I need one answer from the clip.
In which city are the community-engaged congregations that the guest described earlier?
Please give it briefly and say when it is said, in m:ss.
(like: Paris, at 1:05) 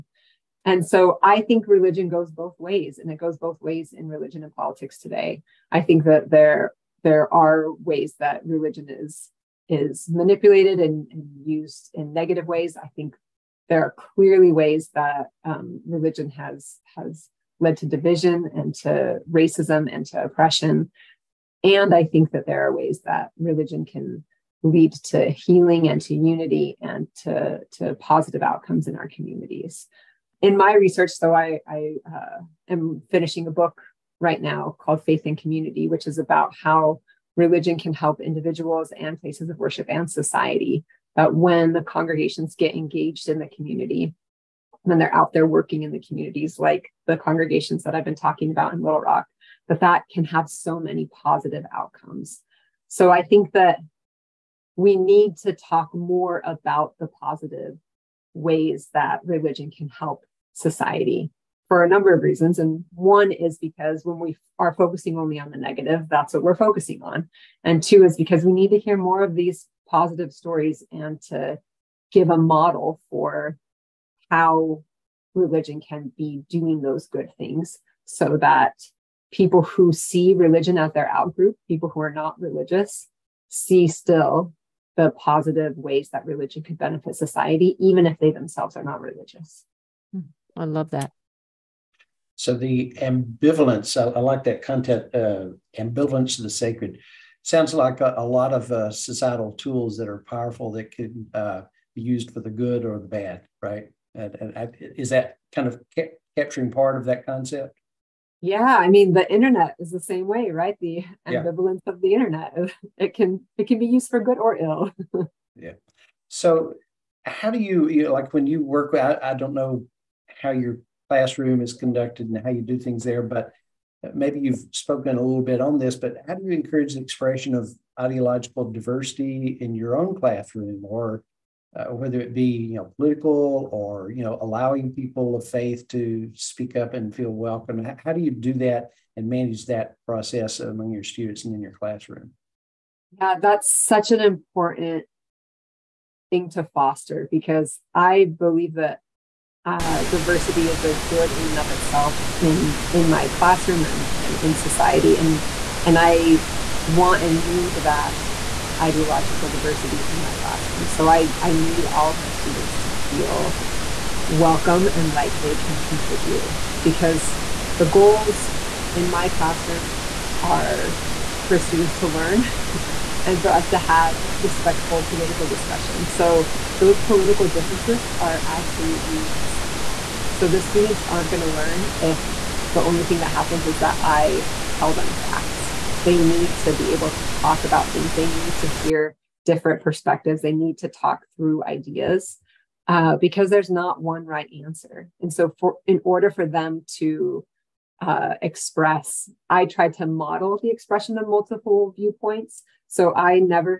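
Little Rock, at 0:48.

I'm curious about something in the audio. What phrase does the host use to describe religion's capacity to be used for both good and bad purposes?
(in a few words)
Ambivalence of the sacred.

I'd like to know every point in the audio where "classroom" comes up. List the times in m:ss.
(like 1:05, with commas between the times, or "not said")
2:01, 2:10, 2:21, 2:33, 2:40, 2:49.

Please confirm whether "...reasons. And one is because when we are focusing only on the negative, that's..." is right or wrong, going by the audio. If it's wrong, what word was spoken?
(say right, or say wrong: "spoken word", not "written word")
right.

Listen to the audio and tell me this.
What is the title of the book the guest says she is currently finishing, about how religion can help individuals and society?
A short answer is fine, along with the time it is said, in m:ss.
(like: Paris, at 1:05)
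Faith and Community, at 0:35.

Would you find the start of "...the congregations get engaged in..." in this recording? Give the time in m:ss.
0:41.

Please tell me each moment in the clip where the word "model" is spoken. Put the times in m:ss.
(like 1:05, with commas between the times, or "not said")
1:12, 3:20.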